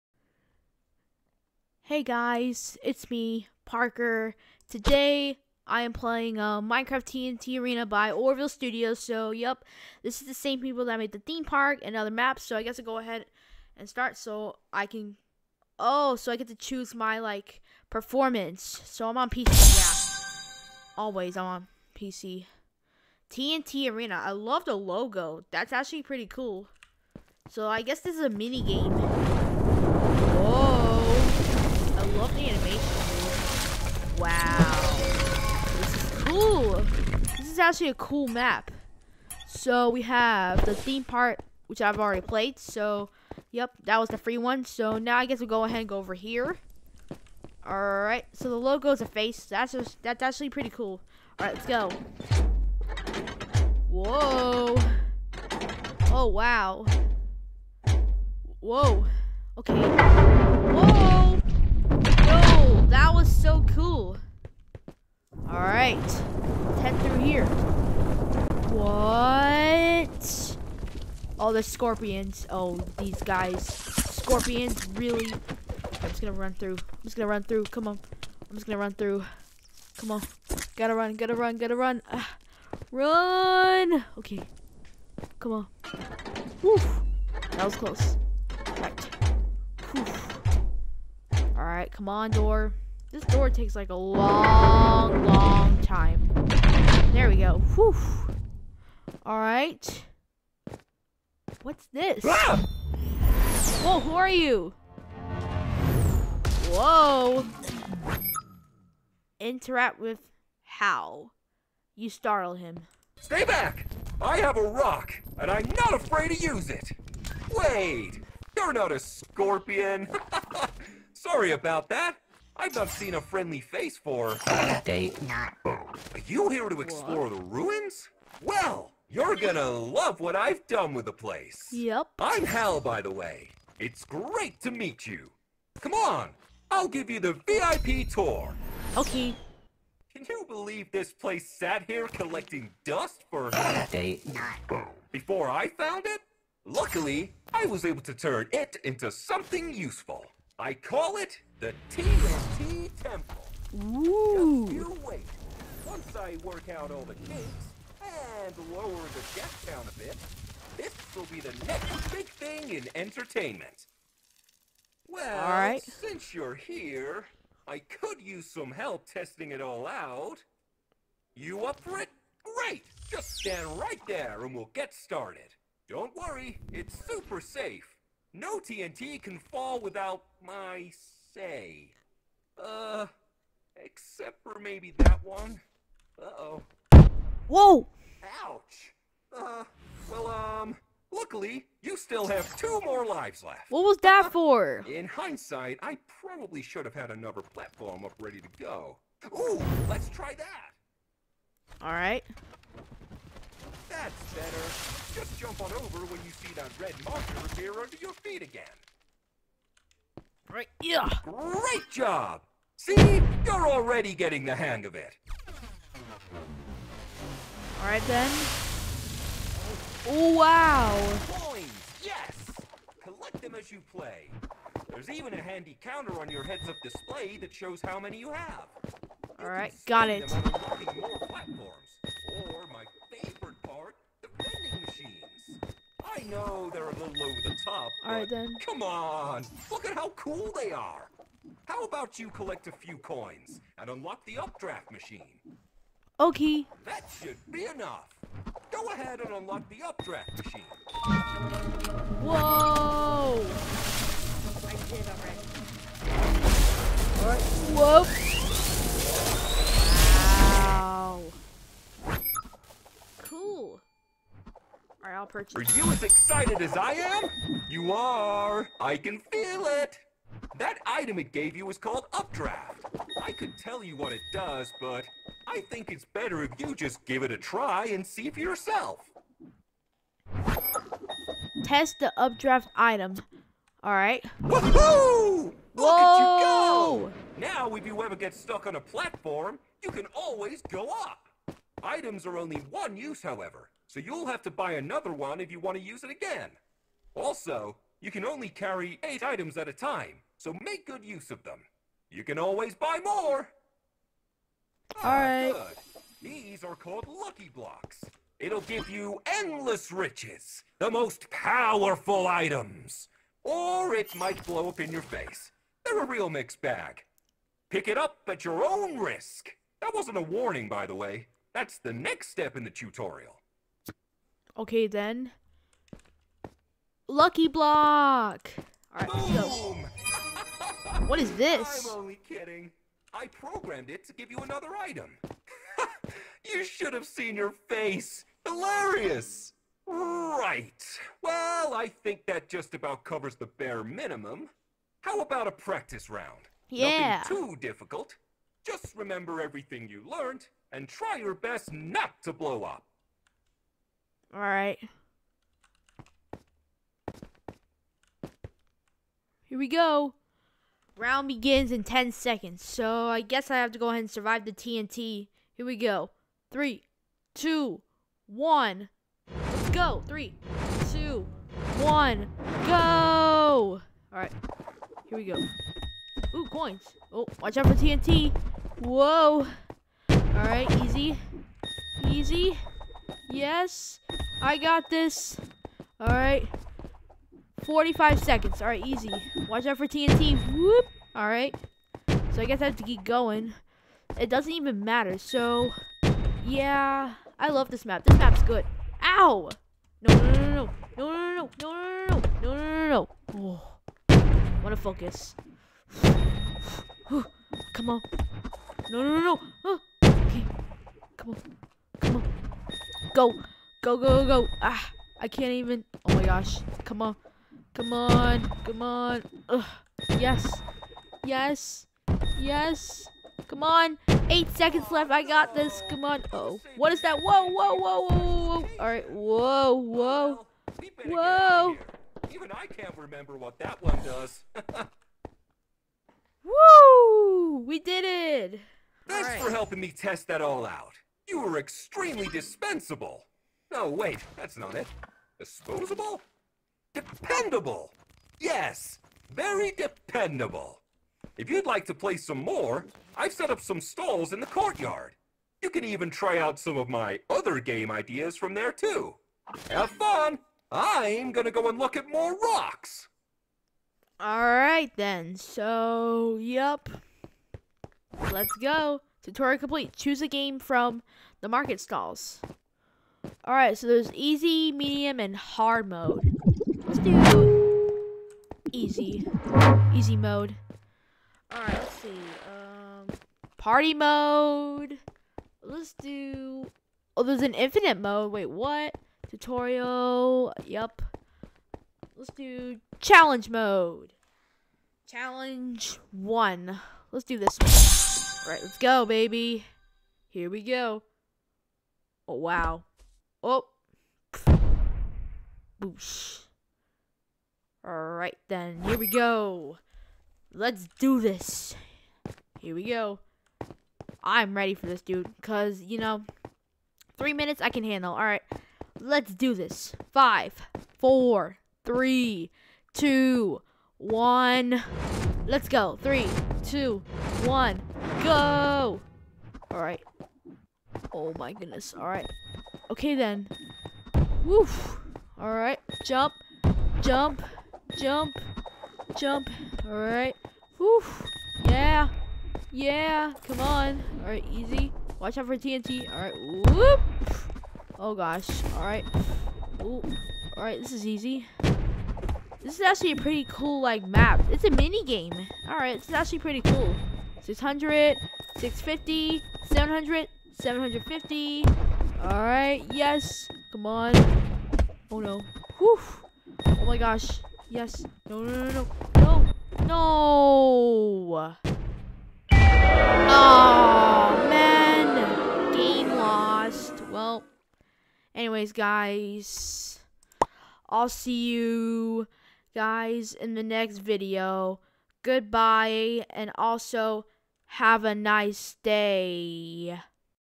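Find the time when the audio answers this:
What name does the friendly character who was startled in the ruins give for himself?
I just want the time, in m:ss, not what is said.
2:12.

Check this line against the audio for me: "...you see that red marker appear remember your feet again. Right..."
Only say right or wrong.
wrong.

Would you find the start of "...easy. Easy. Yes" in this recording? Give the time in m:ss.
6:20.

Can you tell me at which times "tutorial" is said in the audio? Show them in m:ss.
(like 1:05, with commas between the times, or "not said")
5:22, 7:49, 8:09.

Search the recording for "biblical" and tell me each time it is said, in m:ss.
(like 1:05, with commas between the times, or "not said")
not said.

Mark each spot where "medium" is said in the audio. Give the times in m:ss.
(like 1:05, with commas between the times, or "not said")
7:54.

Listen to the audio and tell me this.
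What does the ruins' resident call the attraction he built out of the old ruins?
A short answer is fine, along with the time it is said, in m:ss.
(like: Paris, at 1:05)
TNT Temple, at 2:31.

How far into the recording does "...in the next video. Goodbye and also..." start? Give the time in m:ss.
9:43.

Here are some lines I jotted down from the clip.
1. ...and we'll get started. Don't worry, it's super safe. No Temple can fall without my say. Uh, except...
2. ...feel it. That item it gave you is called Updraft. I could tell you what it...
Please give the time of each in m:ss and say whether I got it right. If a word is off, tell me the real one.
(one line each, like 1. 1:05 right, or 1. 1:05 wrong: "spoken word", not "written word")
1. 2:54 wrong: "TNT", not "Temple"
2. 4:29 right.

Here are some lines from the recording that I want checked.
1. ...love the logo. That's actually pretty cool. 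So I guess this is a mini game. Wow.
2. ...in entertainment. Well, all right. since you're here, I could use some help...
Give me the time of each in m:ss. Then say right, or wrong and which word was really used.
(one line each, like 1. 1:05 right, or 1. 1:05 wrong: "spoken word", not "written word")
1. 0:24 right
2. 2:42 right.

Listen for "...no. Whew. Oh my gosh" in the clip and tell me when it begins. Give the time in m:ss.
9:25.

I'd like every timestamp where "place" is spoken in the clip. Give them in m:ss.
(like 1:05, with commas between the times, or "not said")
2:11, 2:21.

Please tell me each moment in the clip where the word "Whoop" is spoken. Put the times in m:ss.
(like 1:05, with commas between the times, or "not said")
6:30, 9:06.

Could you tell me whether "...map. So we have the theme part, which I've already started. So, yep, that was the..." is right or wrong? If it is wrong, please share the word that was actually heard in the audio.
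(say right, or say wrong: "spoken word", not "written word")
wrong: "played", not "started".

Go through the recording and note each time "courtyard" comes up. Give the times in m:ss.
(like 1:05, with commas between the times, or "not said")
7:34.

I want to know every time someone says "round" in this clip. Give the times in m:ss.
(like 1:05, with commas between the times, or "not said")
5:46, 6:00.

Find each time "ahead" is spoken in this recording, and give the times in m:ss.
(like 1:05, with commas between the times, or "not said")
0:12, 0:45, 4:08, 6:03.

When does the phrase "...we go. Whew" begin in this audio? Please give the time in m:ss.
1:37.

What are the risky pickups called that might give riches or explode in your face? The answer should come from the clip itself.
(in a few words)
Lucky Blocks.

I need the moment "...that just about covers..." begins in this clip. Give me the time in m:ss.
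5:42.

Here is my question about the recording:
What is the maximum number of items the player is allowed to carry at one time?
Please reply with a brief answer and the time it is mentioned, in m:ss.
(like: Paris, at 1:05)
8, at 4:59.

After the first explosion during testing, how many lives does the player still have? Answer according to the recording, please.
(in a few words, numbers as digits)
2.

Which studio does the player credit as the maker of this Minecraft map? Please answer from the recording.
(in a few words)
Oreville Studios.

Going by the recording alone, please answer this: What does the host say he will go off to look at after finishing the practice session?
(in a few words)
rocks.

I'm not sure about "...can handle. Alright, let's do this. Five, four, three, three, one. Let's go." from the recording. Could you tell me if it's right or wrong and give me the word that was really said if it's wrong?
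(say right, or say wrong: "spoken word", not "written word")
wrong: "two", not "three".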